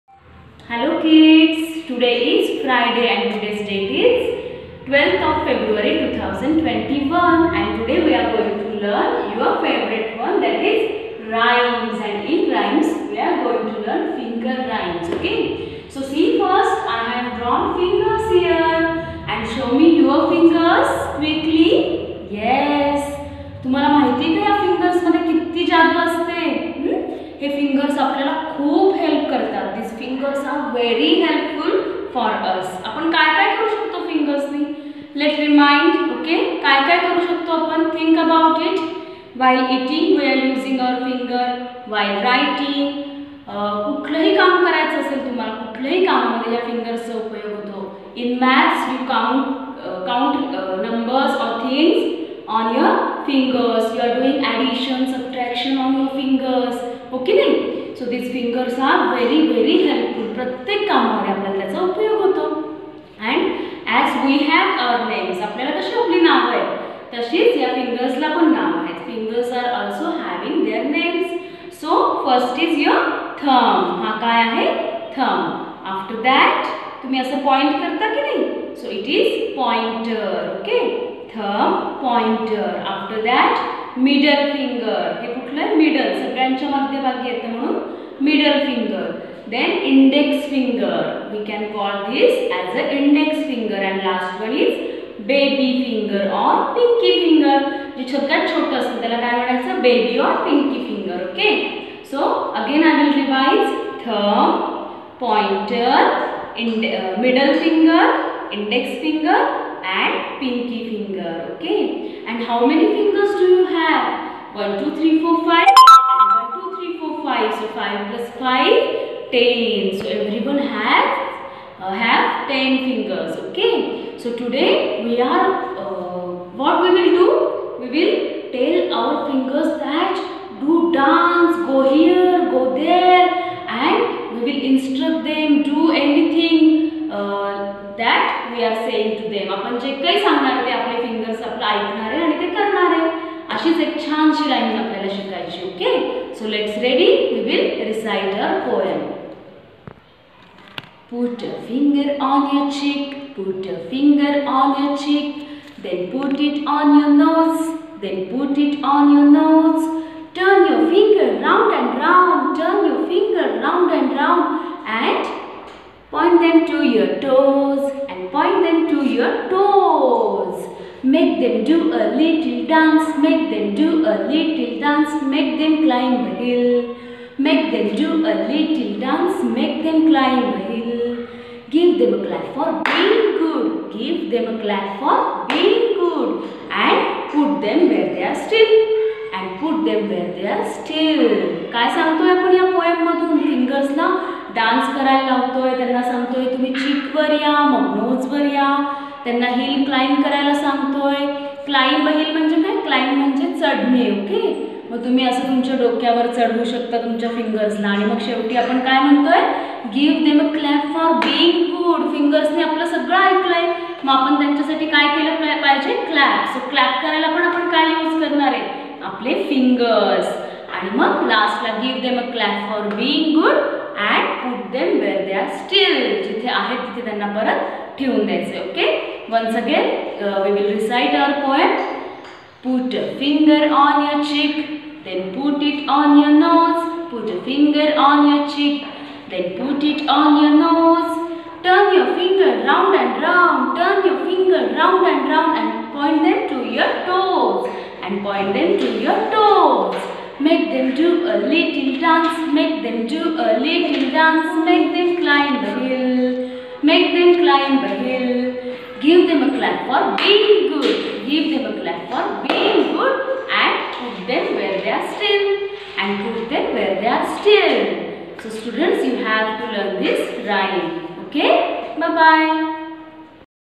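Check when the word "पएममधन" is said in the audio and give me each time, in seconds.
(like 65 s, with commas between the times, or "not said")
192 s.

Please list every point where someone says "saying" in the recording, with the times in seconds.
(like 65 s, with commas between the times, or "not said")
138 s.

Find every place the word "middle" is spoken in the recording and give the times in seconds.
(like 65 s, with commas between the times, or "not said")
88 s, 107 s.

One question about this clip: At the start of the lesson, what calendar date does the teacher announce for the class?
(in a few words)
12 February 2021.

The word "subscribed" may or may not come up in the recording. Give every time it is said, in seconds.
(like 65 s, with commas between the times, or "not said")
not said.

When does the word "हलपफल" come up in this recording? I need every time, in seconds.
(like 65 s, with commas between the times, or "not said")
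31 s, 59 s.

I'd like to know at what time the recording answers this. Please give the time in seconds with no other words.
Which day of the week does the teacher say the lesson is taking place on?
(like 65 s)
2 s.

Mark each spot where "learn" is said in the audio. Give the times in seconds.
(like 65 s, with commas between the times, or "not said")
8 s, 13 s, 269 s.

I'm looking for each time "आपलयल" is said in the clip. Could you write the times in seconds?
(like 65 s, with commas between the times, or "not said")
61 s, 65 s, 144 s.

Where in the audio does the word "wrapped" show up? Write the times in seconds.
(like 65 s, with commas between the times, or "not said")
not said.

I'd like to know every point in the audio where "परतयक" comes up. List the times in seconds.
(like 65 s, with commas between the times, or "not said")
60 s.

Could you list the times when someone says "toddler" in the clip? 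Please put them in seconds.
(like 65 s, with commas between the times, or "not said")
not said.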